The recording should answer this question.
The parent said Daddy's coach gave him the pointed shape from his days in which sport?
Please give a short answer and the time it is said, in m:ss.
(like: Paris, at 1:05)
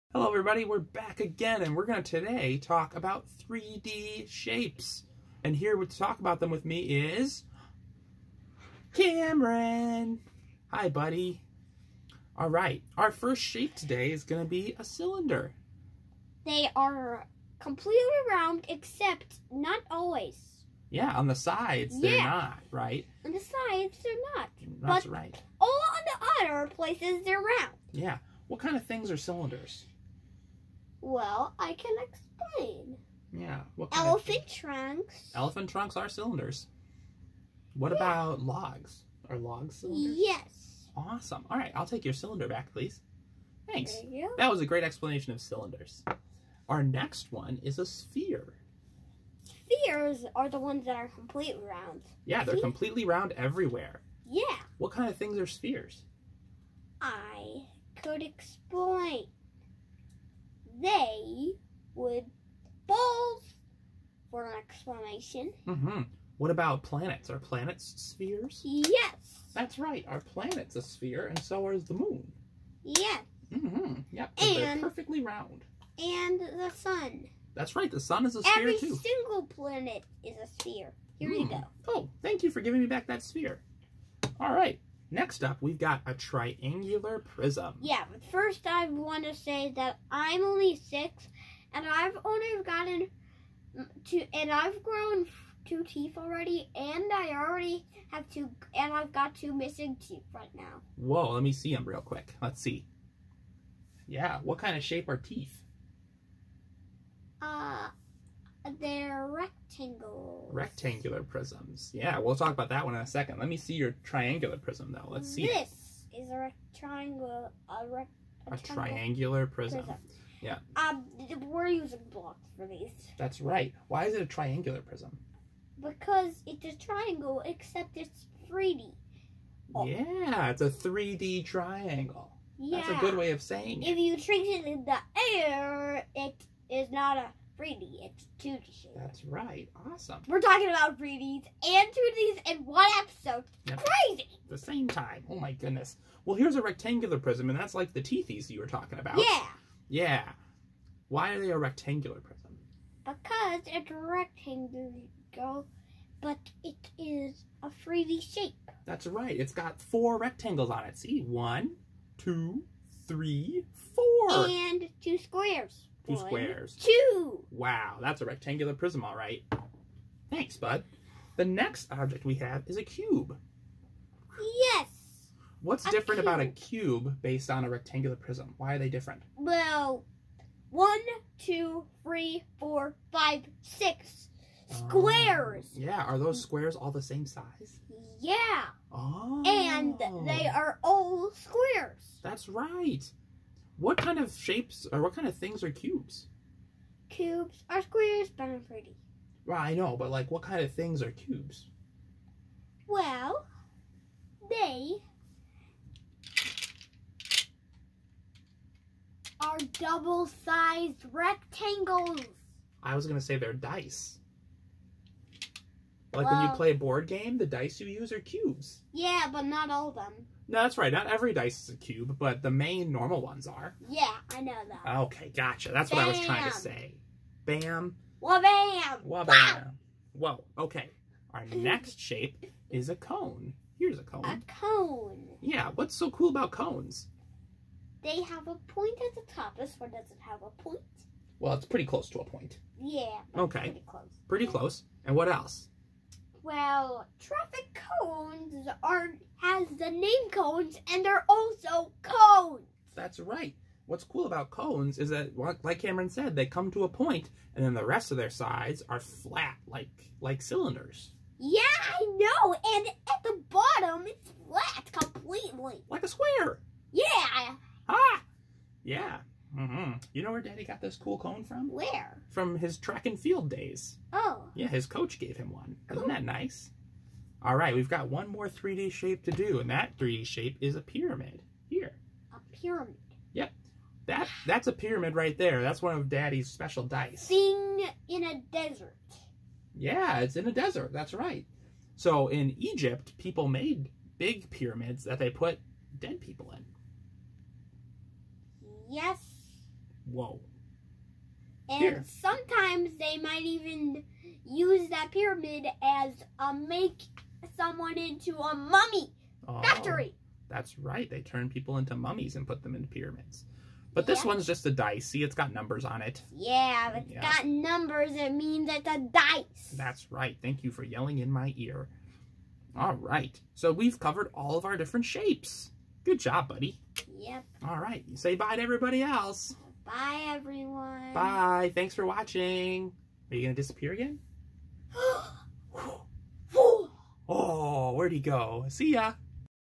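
Track and field, at 4:32.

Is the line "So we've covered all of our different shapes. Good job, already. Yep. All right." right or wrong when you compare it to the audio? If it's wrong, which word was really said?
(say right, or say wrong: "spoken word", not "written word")
wrong: "buddy", not "already".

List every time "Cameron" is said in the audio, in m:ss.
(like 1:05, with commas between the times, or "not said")
0:08, 4:15.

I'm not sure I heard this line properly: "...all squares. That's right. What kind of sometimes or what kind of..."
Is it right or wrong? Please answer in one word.
wrong.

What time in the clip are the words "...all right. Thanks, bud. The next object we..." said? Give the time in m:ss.
2:49.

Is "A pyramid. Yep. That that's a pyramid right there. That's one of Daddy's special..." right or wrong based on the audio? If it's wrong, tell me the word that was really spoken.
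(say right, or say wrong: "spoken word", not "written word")
right.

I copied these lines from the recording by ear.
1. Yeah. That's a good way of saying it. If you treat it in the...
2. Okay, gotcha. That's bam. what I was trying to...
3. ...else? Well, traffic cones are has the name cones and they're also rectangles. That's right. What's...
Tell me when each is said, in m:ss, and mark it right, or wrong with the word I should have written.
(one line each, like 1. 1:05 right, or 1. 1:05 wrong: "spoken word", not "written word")
1. 2:12 right
2. 3:45 right
3. 4:05 wrong: "cones", not "rectangles".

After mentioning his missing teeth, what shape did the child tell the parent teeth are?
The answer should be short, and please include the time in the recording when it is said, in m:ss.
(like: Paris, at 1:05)
Rectangular prisms, at 1:50.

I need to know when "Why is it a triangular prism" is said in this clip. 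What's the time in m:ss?
2:03.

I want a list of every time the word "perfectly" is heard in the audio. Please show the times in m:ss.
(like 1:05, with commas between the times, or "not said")
1:14.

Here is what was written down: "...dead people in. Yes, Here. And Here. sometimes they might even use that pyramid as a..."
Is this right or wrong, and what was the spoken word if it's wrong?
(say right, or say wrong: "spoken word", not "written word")
wrong: "Whoa", not "Here".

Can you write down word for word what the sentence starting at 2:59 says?
Well, one, two, three, four, five, six squares.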